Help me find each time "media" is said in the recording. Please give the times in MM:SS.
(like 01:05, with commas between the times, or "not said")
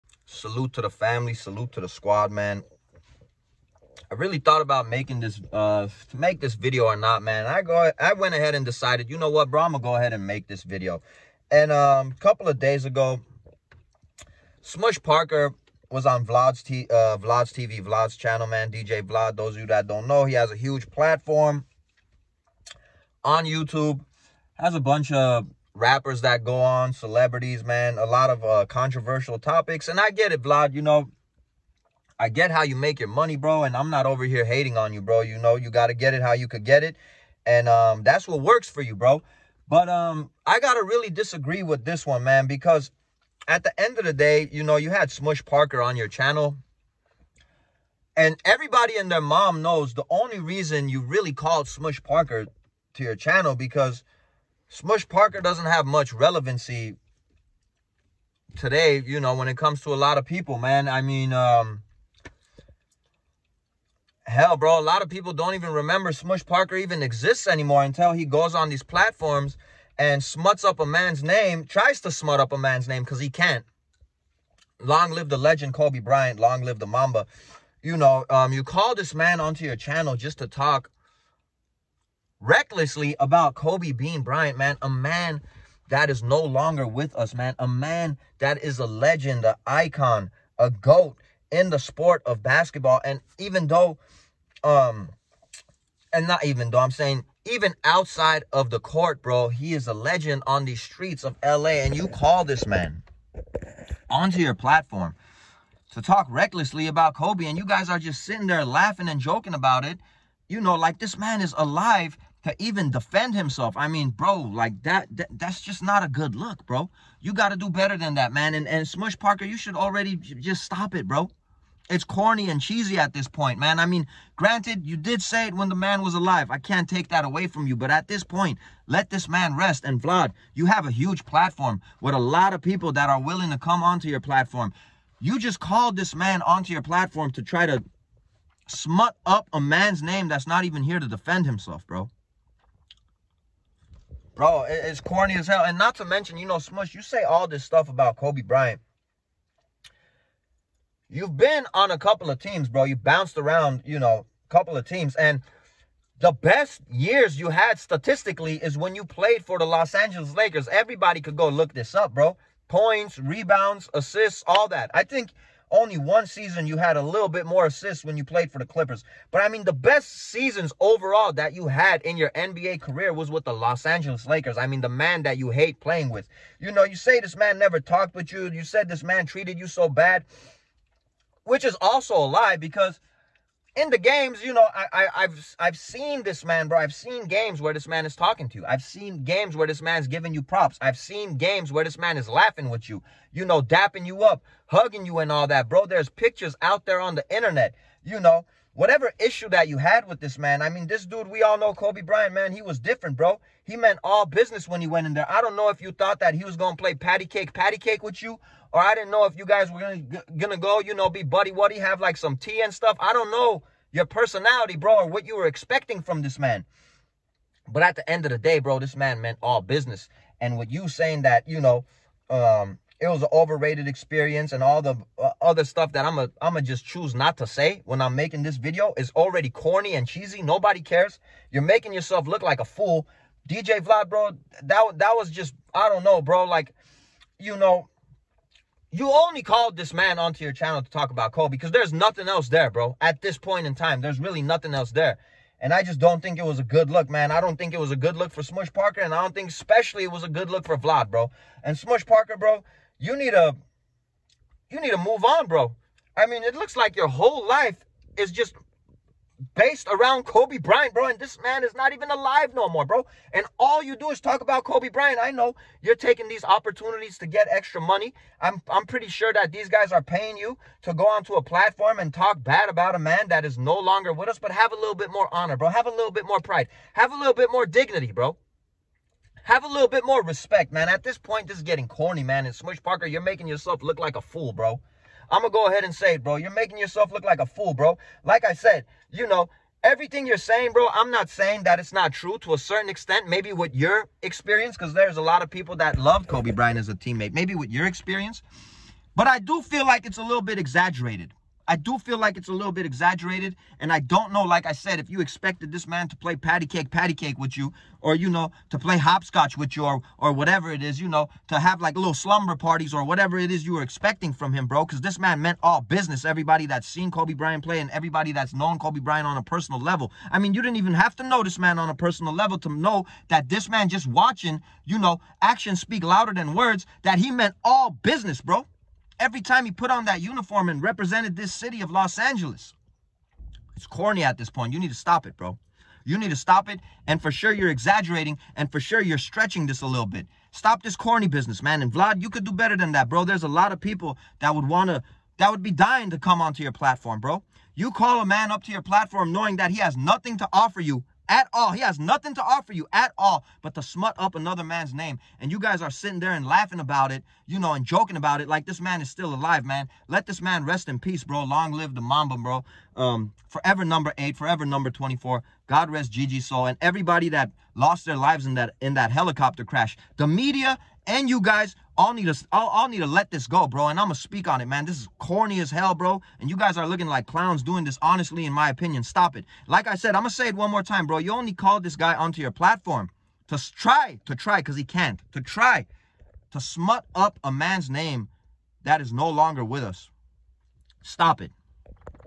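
06:10.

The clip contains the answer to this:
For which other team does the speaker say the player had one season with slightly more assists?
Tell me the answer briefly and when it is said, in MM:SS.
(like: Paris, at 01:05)
Clippers, at 02:48.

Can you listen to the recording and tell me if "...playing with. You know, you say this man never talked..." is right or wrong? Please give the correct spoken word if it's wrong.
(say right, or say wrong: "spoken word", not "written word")
right.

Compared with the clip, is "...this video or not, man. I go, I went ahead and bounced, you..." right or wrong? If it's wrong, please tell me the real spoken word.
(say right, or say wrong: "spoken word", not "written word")
wrong: "decided", not "bounced".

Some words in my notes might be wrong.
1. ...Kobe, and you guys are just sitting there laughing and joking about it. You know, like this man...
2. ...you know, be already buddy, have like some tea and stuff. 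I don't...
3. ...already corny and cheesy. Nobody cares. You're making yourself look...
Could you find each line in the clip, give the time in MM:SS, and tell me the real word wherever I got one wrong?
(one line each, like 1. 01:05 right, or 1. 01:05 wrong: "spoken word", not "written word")
1. 01:47 right
2. 03:30 wrong: "buddy", not "already"
3. 03:49 right.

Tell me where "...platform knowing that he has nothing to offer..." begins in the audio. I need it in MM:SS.
05:48.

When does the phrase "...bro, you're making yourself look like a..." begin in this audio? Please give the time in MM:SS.
04:46.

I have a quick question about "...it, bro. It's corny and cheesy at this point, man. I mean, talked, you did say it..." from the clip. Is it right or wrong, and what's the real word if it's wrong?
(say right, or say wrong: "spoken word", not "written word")
wrong: "granted", not "talked".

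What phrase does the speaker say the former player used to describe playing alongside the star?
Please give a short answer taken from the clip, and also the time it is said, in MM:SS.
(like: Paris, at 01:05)
overrated experience, at 03:43.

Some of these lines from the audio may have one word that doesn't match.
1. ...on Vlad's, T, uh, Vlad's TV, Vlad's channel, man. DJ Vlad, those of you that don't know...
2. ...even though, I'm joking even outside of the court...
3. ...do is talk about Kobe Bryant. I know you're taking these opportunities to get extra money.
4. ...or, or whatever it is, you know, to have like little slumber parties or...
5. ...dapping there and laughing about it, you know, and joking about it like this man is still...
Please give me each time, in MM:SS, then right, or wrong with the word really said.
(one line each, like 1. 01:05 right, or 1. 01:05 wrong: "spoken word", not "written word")
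1. 00:16 right
2. 01:36 wrong: "saying", not "joking"
3. 04:23 right
4. 05:09 right
5. 05:55 wrong: "sitting", not "dapping".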